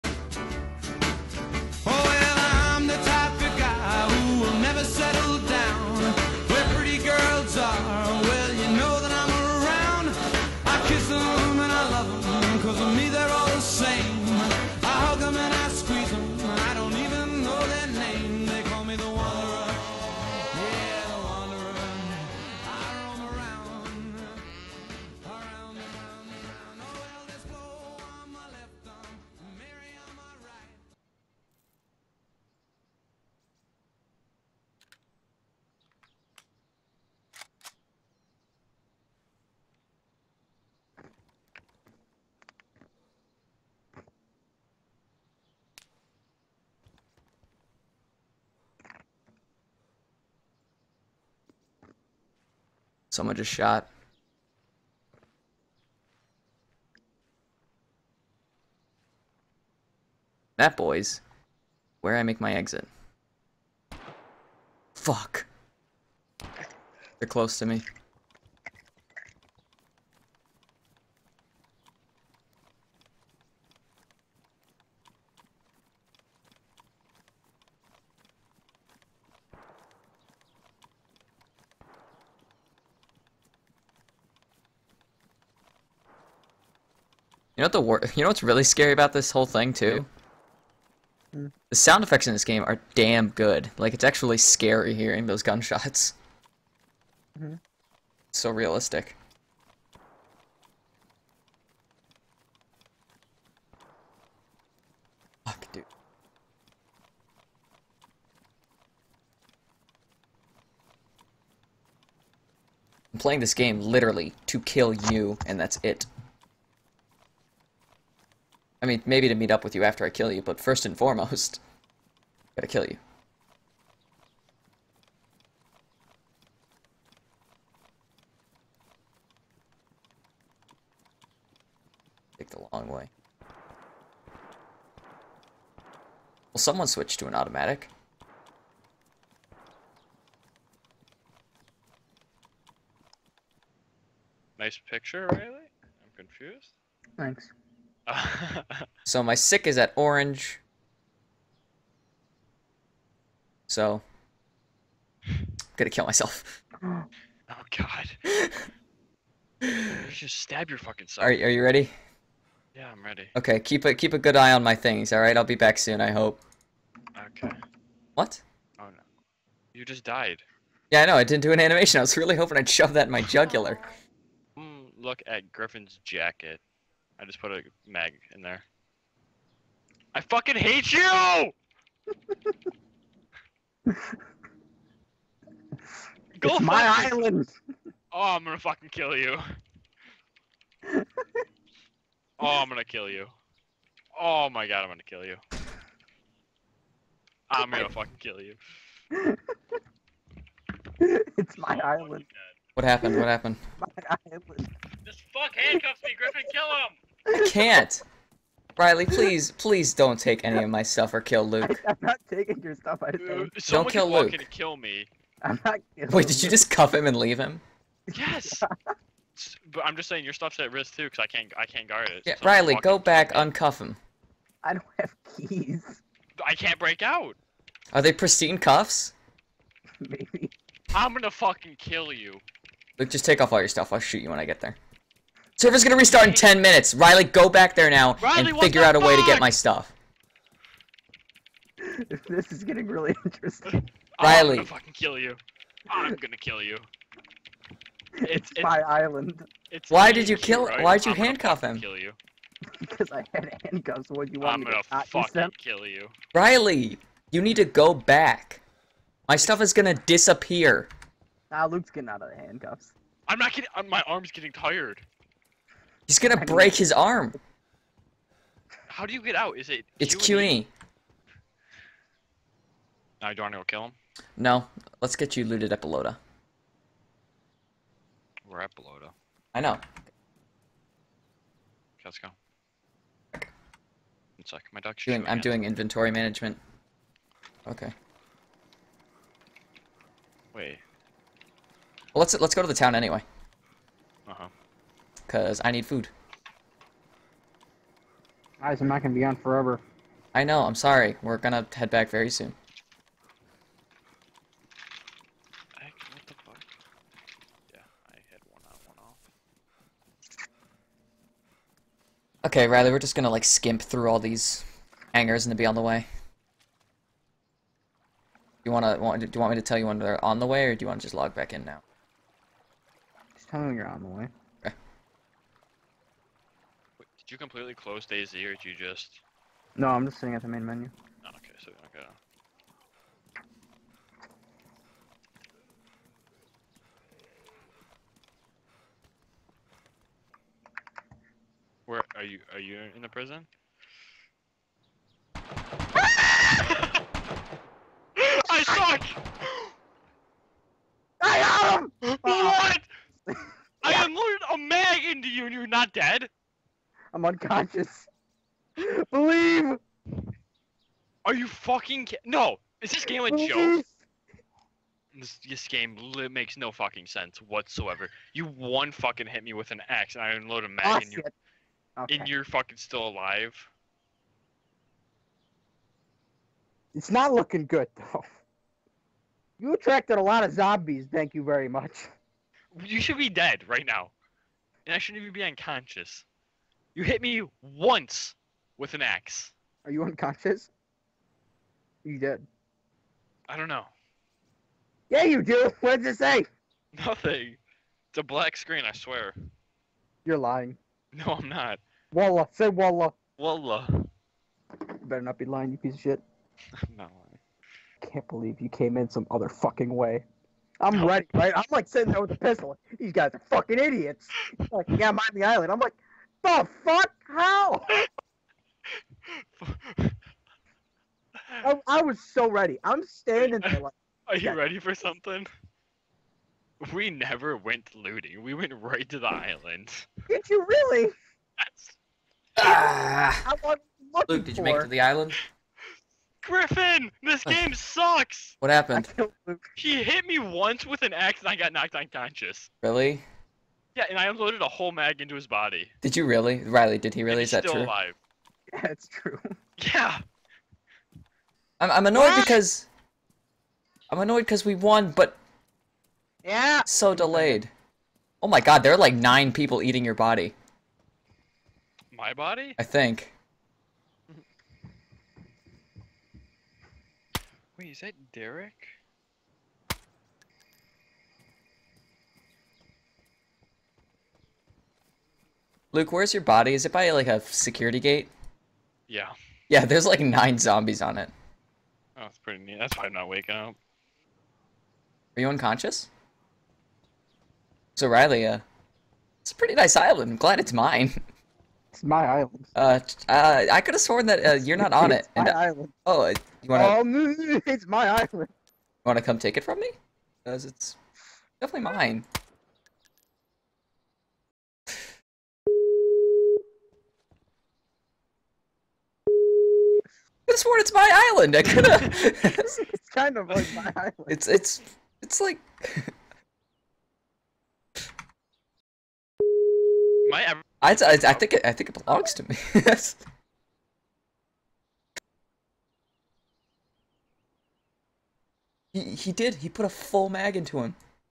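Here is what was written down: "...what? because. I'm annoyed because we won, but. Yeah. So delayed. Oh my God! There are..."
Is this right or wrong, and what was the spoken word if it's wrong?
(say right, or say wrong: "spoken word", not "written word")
right.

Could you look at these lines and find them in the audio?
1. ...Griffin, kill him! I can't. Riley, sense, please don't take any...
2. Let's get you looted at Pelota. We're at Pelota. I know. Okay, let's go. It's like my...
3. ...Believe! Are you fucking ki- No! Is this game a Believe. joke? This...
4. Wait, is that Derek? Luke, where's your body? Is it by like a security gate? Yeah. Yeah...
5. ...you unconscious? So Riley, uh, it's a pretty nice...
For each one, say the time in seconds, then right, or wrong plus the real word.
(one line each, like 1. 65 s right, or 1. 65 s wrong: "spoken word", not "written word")
1. 206 s wrong: "please", not "sense"
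2. 274 s right
3. 359 s right
4. 467 s right
5. 485 s right.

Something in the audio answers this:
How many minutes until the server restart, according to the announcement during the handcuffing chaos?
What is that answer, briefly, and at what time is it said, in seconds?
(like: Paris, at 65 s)
10, at 236 s.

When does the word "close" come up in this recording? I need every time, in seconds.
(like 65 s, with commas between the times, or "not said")
67 s, 327 s.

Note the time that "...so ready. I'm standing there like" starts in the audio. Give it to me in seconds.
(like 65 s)
422 s.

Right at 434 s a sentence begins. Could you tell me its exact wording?
Luke, did you make it to the island?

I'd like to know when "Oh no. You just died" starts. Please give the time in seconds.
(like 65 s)
168 s.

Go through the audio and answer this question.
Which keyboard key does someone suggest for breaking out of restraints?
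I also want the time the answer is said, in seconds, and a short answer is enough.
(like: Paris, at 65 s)
Q, at 270 s.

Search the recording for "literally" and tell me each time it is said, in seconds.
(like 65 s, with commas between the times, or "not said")
113 s.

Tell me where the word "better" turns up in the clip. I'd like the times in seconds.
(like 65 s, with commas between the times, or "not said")
405 s.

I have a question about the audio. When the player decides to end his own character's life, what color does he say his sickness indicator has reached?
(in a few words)
Orange.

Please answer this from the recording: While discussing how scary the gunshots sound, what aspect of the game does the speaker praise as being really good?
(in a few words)
Sound effects.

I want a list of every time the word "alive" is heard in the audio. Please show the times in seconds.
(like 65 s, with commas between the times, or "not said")
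373 s, 447 s.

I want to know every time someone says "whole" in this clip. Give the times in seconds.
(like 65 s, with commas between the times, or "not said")
89 s, 444 s.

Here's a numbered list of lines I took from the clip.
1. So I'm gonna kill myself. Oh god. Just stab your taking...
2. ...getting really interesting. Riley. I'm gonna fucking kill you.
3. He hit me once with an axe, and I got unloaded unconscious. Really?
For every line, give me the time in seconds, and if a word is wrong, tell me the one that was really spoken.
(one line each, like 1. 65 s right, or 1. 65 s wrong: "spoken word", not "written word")
1. 153 s wrong: "fucking", not "taking"
2. 242 s right
3. 439 s wrong: "knocked", not "unloaded".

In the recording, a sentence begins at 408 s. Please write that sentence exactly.
can't believe you came in some other fucking way.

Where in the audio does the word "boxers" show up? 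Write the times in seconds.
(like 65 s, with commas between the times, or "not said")
not said.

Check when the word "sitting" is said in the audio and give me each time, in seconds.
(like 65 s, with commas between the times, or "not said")
330 s, 411 s.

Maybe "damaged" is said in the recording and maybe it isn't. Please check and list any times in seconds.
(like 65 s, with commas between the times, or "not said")
not said.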